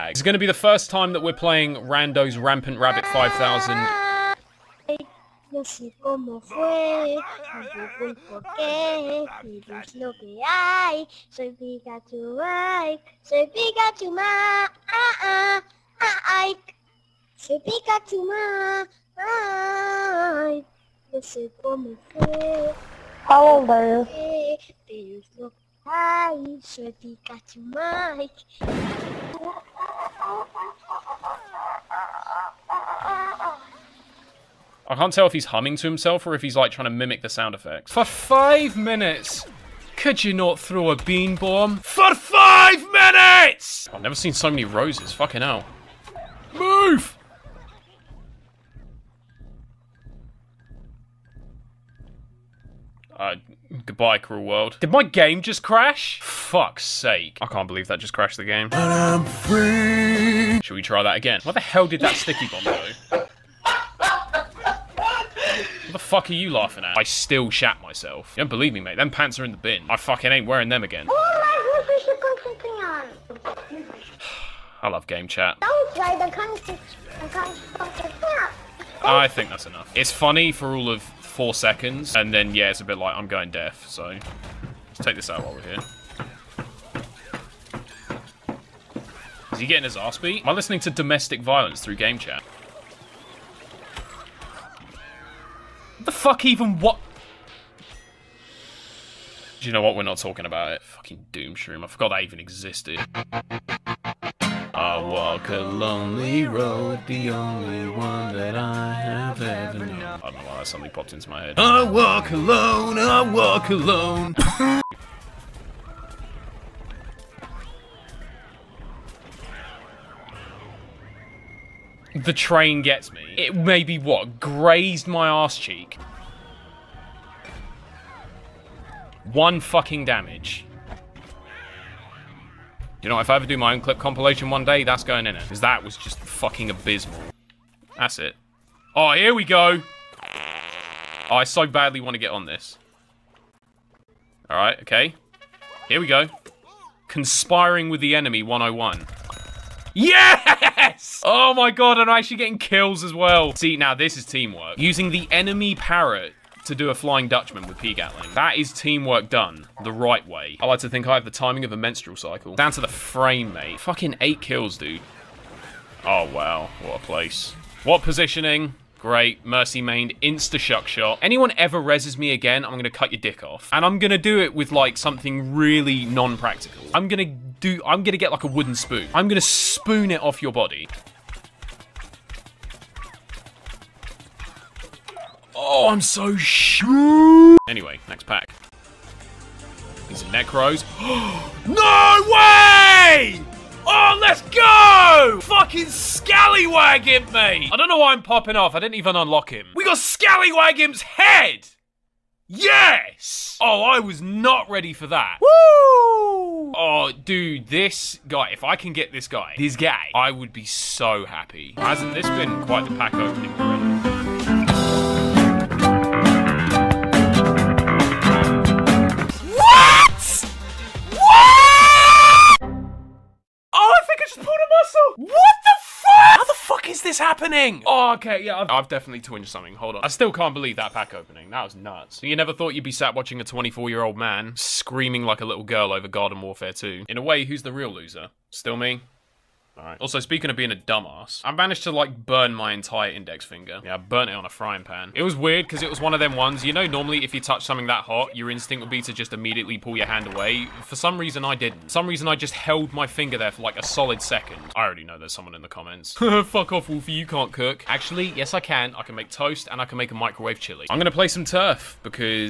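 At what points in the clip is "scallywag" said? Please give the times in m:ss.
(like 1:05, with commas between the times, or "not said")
3:15, 3:19.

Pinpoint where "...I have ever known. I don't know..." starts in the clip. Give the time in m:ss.
1:48.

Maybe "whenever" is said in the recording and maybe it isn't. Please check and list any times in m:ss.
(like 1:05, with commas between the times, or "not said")
not said.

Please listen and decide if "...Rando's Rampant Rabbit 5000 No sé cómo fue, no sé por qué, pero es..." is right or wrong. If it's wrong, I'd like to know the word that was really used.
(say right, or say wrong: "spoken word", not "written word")
right.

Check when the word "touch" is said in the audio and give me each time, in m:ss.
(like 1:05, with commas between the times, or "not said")
4:07.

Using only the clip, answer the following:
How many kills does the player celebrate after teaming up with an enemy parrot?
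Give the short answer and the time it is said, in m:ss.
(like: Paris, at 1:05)
8, at 2:44.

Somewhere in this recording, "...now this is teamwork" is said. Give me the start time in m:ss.
2:33.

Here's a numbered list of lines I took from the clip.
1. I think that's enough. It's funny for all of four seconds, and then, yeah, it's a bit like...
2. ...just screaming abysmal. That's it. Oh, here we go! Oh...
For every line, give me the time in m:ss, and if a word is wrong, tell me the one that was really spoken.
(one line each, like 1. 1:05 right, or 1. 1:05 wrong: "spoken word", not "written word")
1. 1:15 right
2. 2:15 wrong: "fucking", not "screaming".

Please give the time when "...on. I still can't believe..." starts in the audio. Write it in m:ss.
3:49.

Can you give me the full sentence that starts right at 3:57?
In a way, who's the real loser?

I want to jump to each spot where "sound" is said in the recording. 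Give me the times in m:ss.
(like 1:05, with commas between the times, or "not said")
0:37.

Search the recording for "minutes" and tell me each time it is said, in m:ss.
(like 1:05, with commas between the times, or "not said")
0:38, 0:42.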